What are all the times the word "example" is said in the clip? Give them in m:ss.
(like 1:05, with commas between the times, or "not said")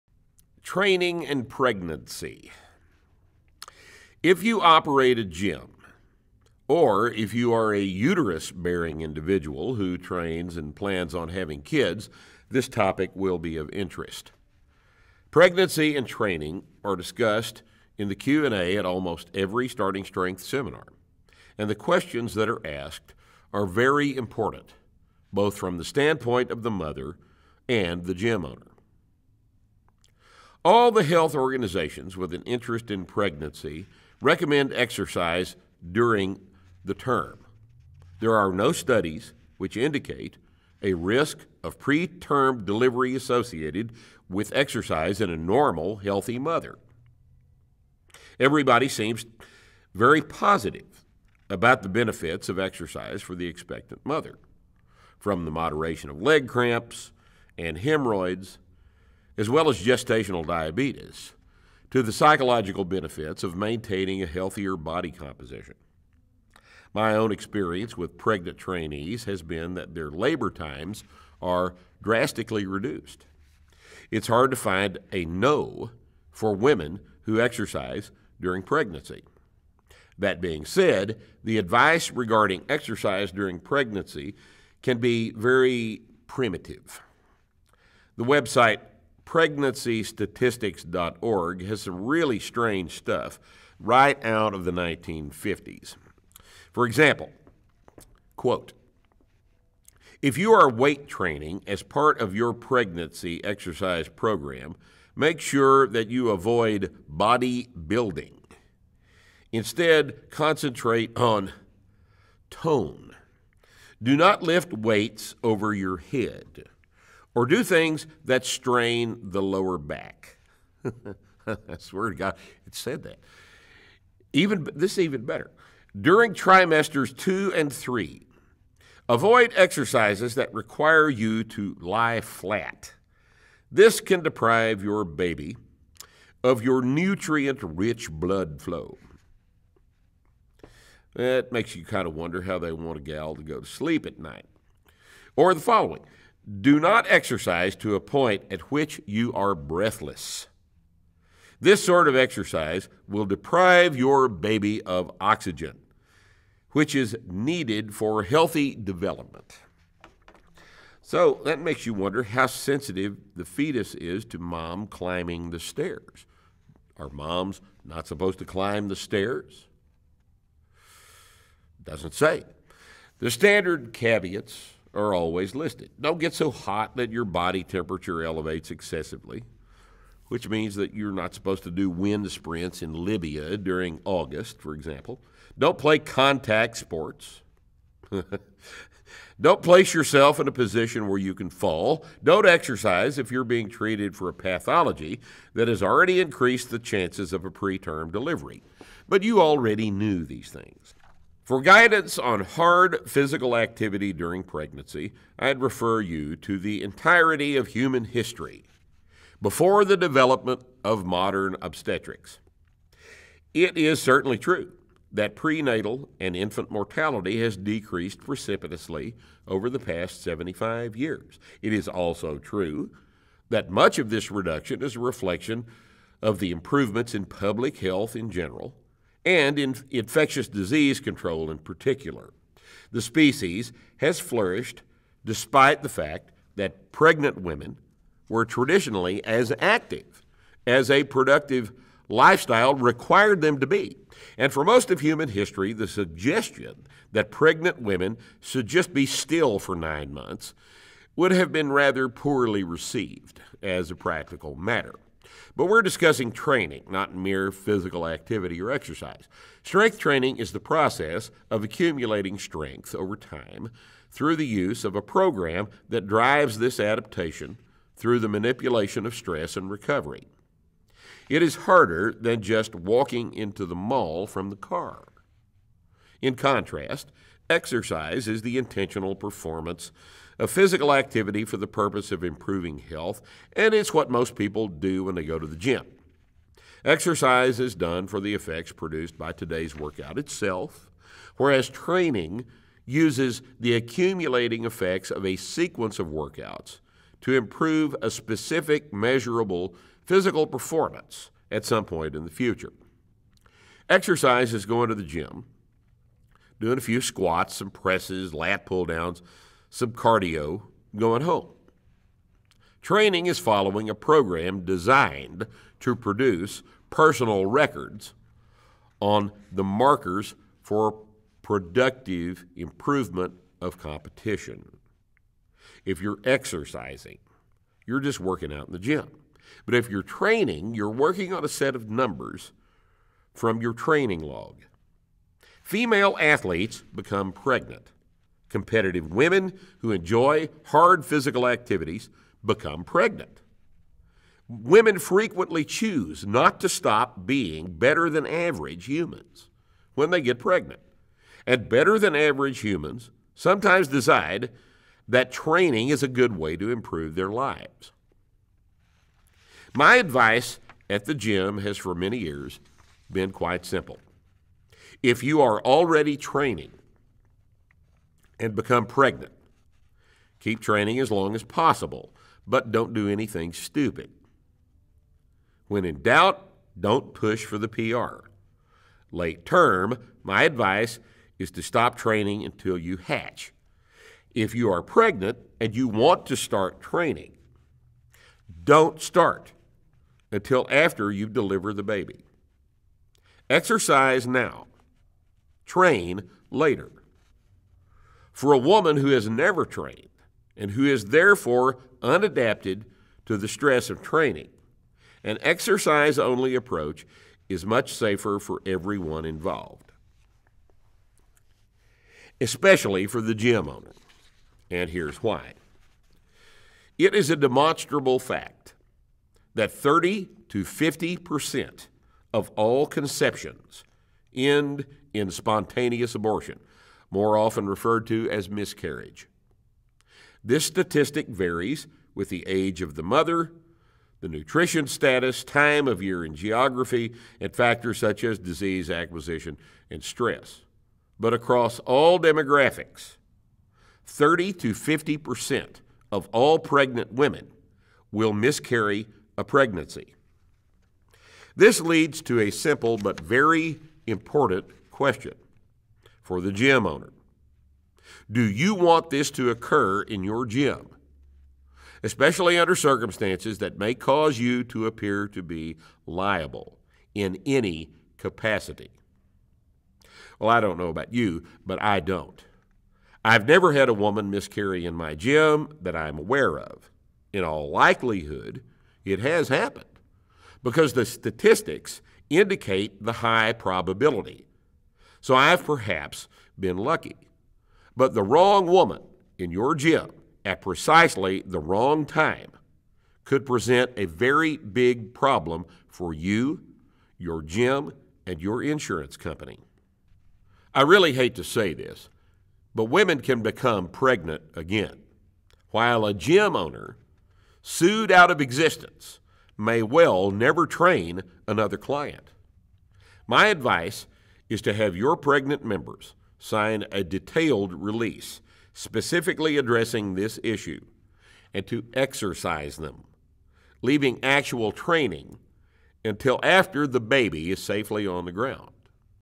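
1:36, 3:04.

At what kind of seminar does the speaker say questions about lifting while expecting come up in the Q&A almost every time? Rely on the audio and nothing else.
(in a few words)
Starting Strength.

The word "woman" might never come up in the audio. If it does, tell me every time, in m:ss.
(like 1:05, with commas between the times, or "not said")
6:38, 7:53, 8:08.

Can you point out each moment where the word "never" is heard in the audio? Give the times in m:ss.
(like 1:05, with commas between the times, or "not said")
6:39, 7:53, 8:30.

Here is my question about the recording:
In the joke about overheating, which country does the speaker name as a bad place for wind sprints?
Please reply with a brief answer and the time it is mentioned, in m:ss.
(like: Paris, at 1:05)
Libya, at 3:02.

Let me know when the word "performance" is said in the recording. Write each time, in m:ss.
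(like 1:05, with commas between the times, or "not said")
4:39, 5:00.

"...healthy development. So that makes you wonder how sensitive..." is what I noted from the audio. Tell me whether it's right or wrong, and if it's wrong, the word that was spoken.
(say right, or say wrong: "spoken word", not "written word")
right.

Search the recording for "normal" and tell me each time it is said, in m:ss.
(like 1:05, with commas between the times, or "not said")
0:45.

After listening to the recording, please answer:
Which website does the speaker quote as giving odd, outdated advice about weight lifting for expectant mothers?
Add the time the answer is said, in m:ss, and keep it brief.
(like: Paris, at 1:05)
Pregnancystatistics.org, at 1:29.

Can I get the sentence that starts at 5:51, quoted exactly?
And better than average humans sometimes decide that training is a good way to improve their lives.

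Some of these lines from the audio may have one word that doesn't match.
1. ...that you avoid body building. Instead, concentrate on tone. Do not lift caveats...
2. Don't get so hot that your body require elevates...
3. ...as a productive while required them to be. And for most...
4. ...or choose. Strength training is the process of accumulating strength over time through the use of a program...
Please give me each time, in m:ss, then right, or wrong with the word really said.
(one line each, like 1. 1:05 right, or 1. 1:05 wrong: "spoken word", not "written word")
1. 1:45 wrong: "weights", not "caveats"
2. 2:55 wrong: "temperature", not "require"
3. 4:00 wrong: "lifestyle", not "while"
4. 4:18 wrong: "exercise", not "choose".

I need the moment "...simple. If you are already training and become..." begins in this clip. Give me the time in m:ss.
6:03.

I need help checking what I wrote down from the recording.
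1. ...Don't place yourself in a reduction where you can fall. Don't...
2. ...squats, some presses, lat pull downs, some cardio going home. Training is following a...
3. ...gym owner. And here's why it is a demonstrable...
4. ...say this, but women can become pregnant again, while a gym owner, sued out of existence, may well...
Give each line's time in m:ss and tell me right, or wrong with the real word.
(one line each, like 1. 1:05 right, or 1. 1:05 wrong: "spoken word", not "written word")
1. 3:09 wrong: "position", not "reduction"
2. 5:06 right
3. 6:53 right
4. 8:21 right.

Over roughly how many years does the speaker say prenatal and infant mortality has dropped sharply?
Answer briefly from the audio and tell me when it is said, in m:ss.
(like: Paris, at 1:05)
75 years, at 3:40.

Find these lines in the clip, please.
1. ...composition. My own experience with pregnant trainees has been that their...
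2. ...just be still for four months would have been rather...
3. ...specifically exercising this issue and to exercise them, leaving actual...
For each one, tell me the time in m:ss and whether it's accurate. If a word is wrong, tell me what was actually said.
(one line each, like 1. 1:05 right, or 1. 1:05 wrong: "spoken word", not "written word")
1. 1:05 right
2. 4:08 wrong: "nine", not "four"
3. 8:38 wrong: "addressing", not "exercising".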